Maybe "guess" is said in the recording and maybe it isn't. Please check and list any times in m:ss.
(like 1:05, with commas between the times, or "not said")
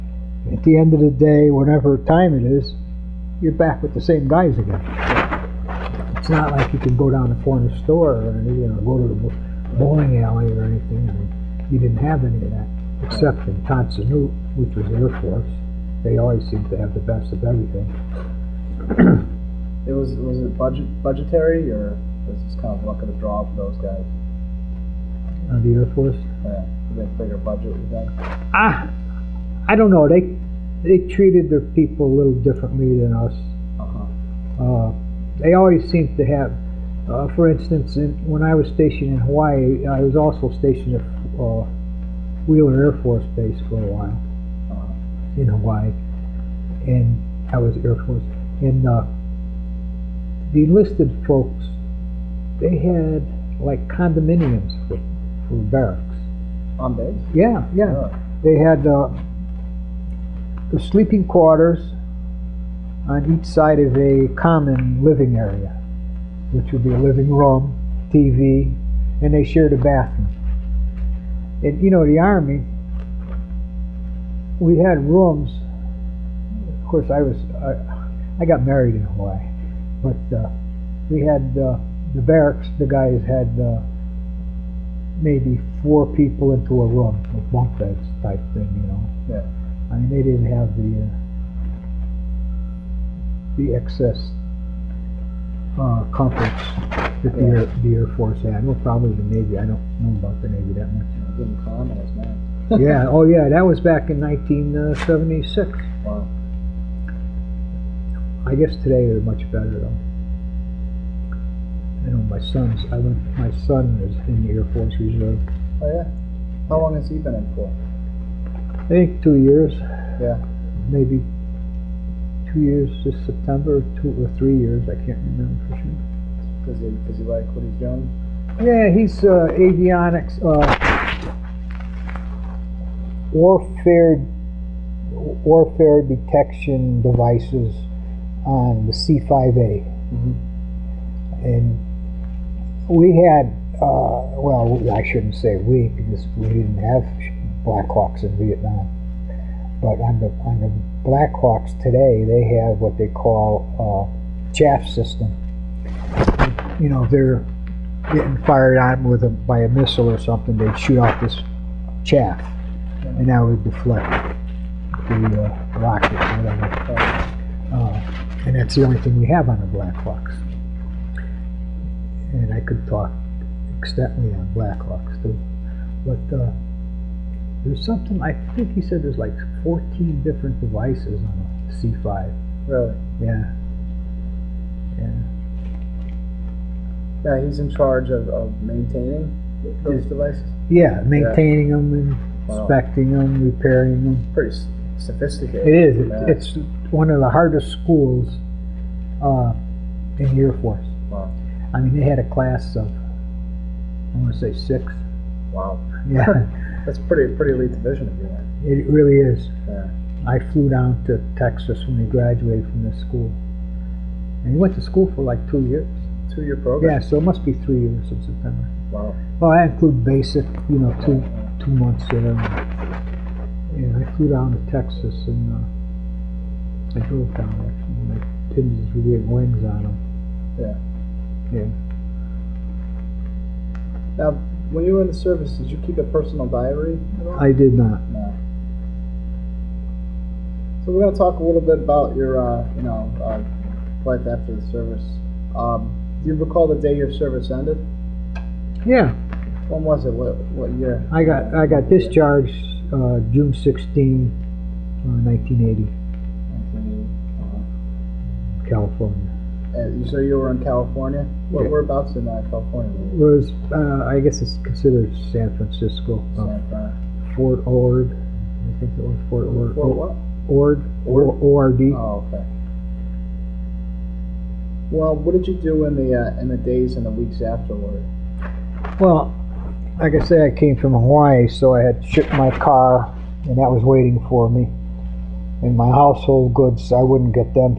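1:48, 4:24.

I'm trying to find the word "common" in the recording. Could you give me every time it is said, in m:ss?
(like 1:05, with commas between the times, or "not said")
1:04, 1:41.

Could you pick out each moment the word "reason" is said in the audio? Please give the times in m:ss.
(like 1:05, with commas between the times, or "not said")
not said.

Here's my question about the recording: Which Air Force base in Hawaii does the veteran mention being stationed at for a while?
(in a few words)
Wheeler Air Force Base.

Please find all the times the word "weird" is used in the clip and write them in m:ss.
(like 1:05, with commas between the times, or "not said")
3:49.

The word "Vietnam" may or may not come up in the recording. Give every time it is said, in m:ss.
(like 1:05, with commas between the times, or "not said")
2:28.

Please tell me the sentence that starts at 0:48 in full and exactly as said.
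And uh, the enlisted folks, they had like condominiums for, for barracks.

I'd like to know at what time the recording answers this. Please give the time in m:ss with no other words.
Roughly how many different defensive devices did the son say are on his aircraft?
2:59.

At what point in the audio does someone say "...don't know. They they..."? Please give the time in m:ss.
0:29.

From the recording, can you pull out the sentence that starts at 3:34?
And he went to school for like two years.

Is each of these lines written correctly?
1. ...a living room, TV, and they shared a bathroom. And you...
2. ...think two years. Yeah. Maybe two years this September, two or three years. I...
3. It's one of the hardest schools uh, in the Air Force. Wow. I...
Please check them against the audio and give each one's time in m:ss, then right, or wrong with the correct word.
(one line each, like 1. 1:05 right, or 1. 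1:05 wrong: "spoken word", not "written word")
1. 1:06 right
2. 1:58 right
3. 3:16 right.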